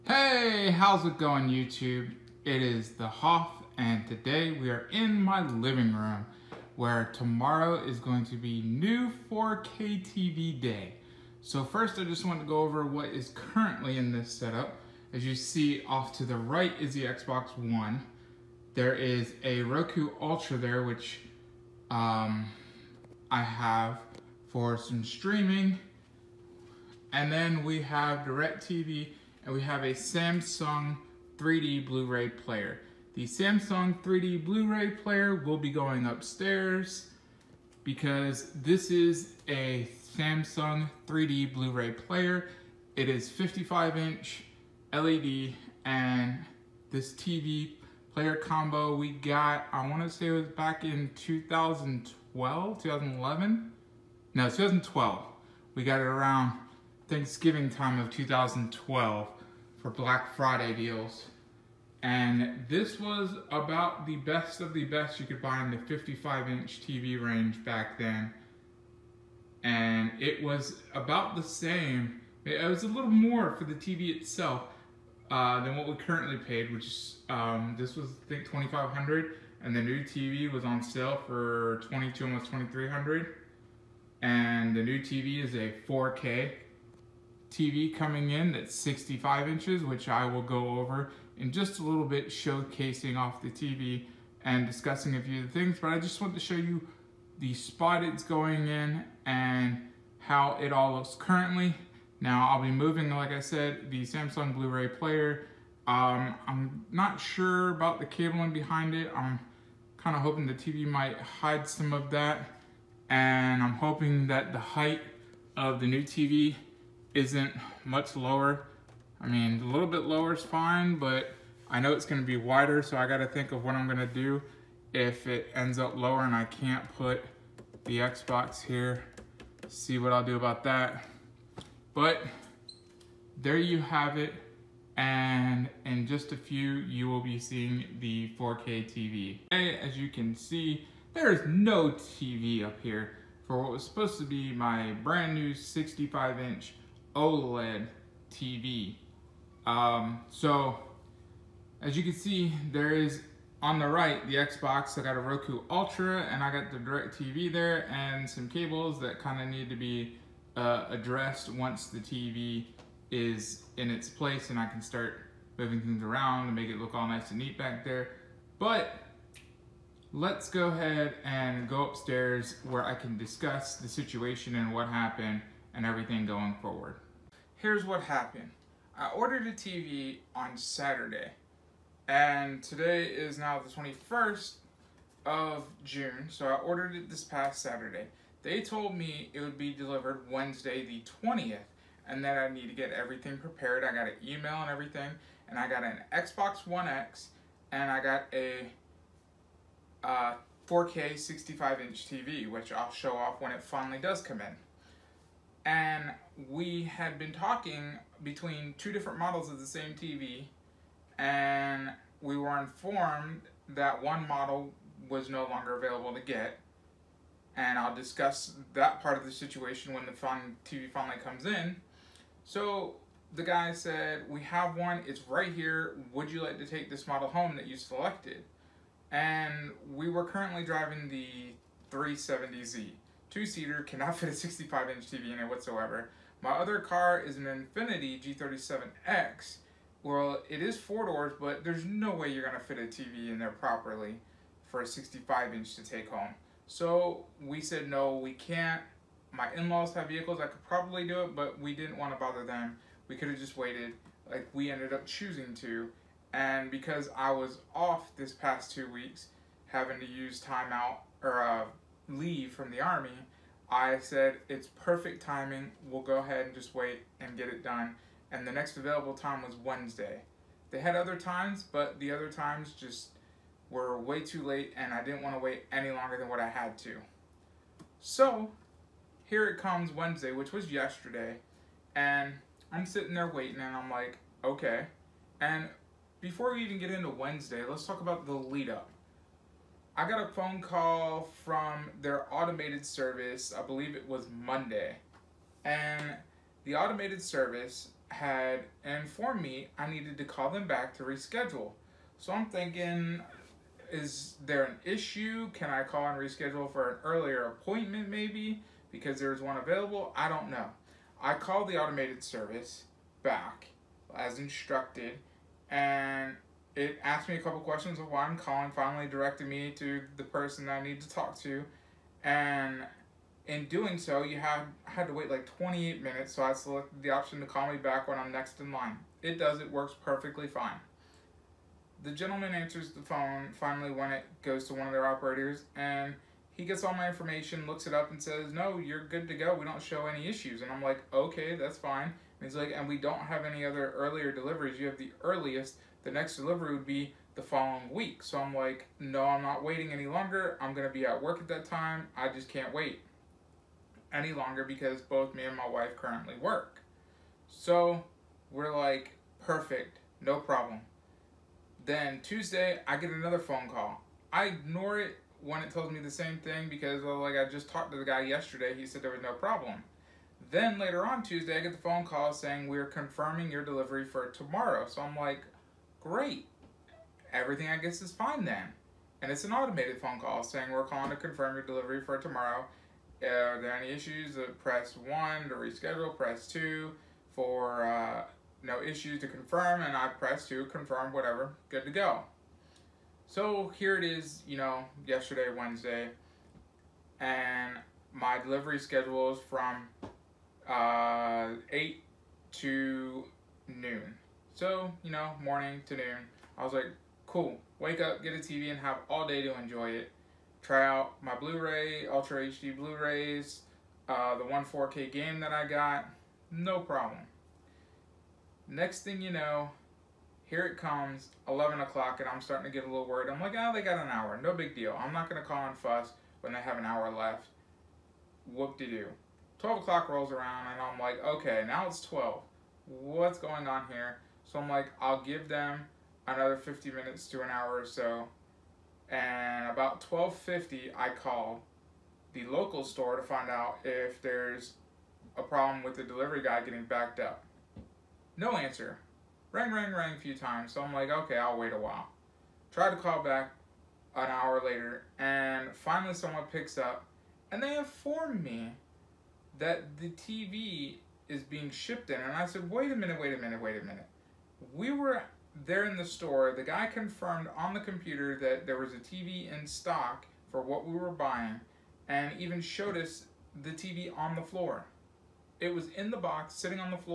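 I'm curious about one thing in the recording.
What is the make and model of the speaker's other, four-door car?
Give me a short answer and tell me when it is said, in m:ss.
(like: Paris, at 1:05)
Infiniti G37X, at 3:57.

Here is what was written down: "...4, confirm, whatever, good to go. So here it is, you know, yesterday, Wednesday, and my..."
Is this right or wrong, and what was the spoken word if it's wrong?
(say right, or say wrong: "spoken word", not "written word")
wrong: "2", not "4".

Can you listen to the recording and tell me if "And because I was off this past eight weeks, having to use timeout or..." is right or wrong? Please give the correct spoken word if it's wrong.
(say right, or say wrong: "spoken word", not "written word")
wrong: "two", not "eight".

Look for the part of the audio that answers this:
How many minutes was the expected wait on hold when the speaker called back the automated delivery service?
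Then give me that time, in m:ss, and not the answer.
5:25.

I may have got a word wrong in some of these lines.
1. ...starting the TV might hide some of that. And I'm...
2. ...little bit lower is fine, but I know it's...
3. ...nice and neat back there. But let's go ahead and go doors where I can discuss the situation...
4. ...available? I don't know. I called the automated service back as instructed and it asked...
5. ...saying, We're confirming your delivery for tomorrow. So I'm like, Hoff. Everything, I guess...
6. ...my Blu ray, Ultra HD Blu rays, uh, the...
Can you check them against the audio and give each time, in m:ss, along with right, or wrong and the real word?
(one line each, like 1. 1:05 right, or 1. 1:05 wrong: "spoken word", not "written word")
1. 1:50 wrong: "hoping", not "starting"
2. 1:59 right
3. 2:47 wrong: "upstairs", not "doors"
4. 5:09 right
5. 6:12 wrong: "Great", not "Hoff"
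6. 6:51 right.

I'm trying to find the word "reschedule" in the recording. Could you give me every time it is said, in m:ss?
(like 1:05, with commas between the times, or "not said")
5:01, 5:06, 6:25.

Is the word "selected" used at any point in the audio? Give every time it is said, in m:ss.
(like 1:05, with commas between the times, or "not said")
3:47, 5:26.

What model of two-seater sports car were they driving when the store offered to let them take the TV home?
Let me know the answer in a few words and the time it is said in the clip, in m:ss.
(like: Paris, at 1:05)
370Z, at 3:51.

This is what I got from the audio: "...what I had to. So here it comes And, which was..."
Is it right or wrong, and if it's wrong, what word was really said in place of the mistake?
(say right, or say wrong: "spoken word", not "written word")
wrong: "Wednesday", not "And".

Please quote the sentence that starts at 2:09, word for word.
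See what I'll do about that.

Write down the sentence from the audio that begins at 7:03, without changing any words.
I'm like, oh, they got an hour, no big deal.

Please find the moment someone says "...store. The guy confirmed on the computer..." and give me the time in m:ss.
7:46.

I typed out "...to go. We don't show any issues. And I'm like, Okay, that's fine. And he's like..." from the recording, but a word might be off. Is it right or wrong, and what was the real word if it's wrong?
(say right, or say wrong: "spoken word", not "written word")
right.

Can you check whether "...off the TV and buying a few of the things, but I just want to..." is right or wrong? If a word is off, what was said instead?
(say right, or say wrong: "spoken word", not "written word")
wrong: "discussing", not "buying".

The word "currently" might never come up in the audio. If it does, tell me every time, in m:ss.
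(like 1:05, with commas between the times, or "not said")
0:13, 1:15, 1:41, 3:50, 5:55.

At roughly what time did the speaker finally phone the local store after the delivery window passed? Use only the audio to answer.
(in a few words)
12:50.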